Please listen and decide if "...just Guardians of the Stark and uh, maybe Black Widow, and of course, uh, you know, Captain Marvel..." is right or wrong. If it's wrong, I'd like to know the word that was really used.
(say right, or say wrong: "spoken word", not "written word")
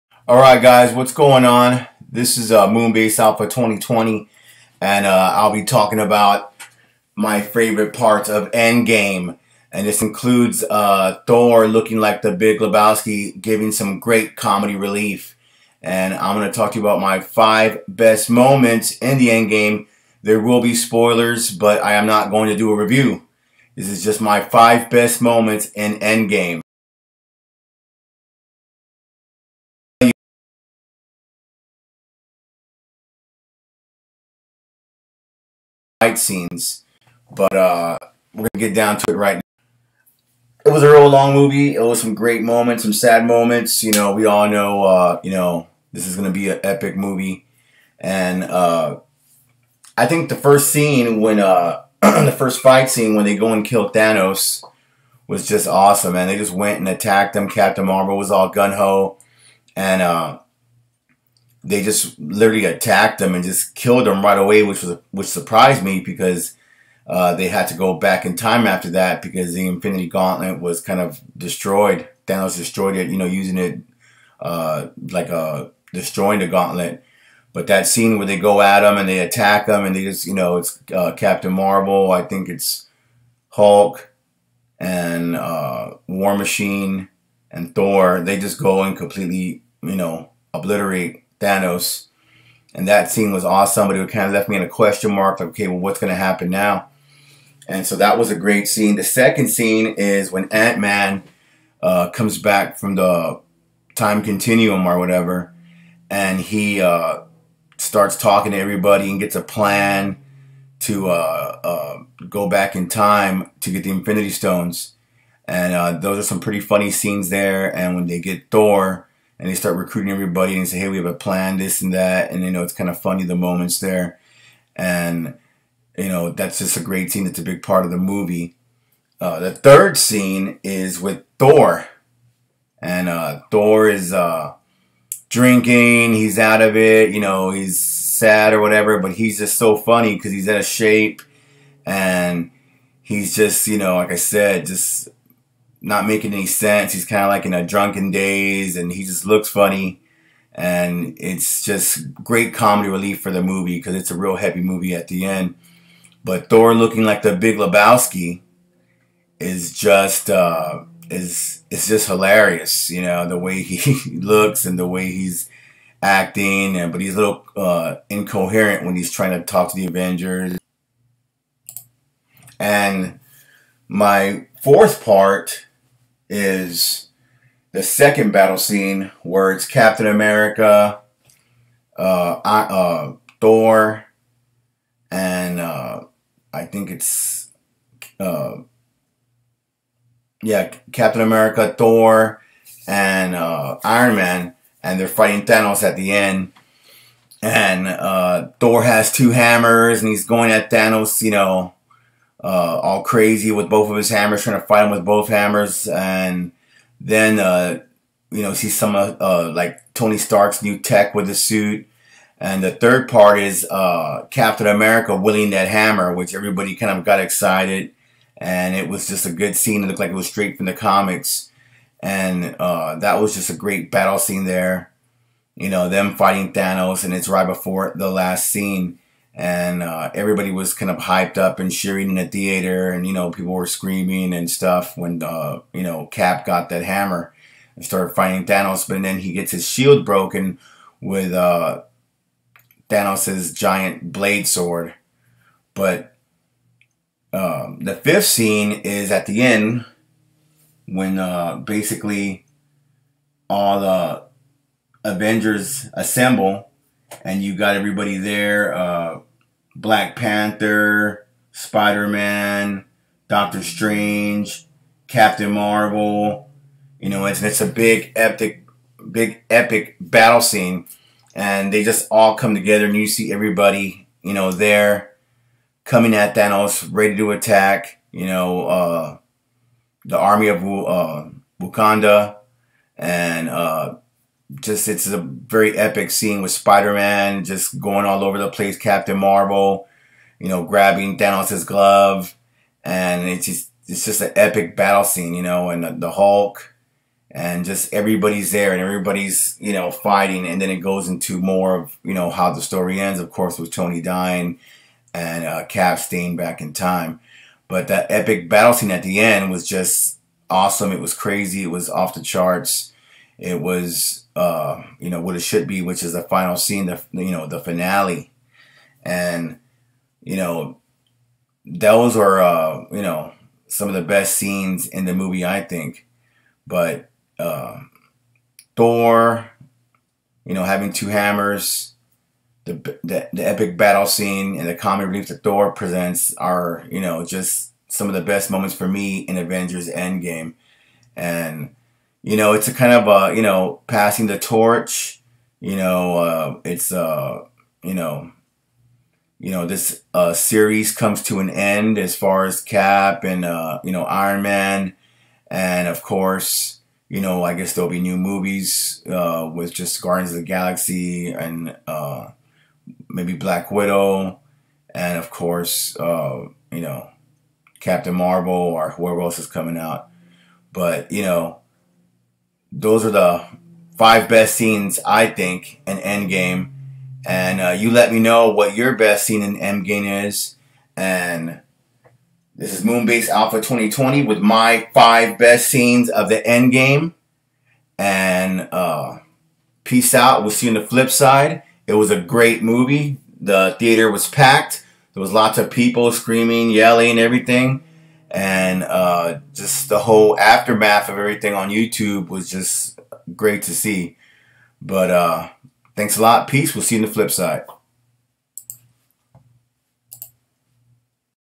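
wrong: "Galaxy", not "Stark".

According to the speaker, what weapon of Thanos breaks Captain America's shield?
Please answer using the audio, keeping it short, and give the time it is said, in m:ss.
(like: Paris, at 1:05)
giant blade sword, at 4:03.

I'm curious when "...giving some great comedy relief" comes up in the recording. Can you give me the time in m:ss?
0:13.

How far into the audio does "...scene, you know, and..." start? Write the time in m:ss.
4:55.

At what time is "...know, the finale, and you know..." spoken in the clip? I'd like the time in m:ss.
5:17.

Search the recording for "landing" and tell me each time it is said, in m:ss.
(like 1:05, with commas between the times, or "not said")
not said.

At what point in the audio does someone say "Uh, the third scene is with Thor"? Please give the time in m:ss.
2:09.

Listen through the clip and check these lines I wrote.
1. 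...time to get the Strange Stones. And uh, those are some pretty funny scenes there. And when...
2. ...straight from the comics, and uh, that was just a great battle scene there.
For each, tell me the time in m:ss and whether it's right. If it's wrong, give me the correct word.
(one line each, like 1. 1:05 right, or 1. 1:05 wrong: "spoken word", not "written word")
1. 1:52 wrong: "Infinity", not "Strange"
2. 3:40 right.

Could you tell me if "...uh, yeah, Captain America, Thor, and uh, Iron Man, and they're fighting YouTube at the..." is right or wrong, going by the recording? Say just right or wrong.
wrong.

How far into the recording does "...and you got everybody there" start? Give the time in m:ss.
4:17.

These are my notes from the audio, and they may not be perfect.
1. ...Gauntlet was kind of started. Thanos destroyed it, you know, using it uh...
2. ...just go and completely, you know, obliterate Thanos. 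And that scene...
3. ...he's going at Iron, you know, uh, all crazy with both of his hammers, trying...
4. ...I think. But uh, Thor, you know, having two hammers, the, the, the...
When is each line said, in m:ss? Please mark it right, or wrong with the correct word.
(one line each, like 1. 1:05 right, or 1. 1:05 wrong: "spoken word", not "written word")
1. 1:10 wrong: "destroyed", not "started"
2. 1:28 right
3. 3:20 wrong: "Thanos", not "Iron"
4. 5:25 right.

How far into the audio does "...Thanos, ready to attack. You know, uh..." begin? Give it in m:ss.
4:36.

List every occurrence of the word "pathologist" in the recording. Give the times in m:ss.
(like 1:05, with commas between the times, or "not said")
not said.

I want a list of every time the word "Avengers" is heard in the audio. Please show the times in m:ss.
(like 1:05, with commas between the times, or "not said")
2:49, 4:15, 5:39.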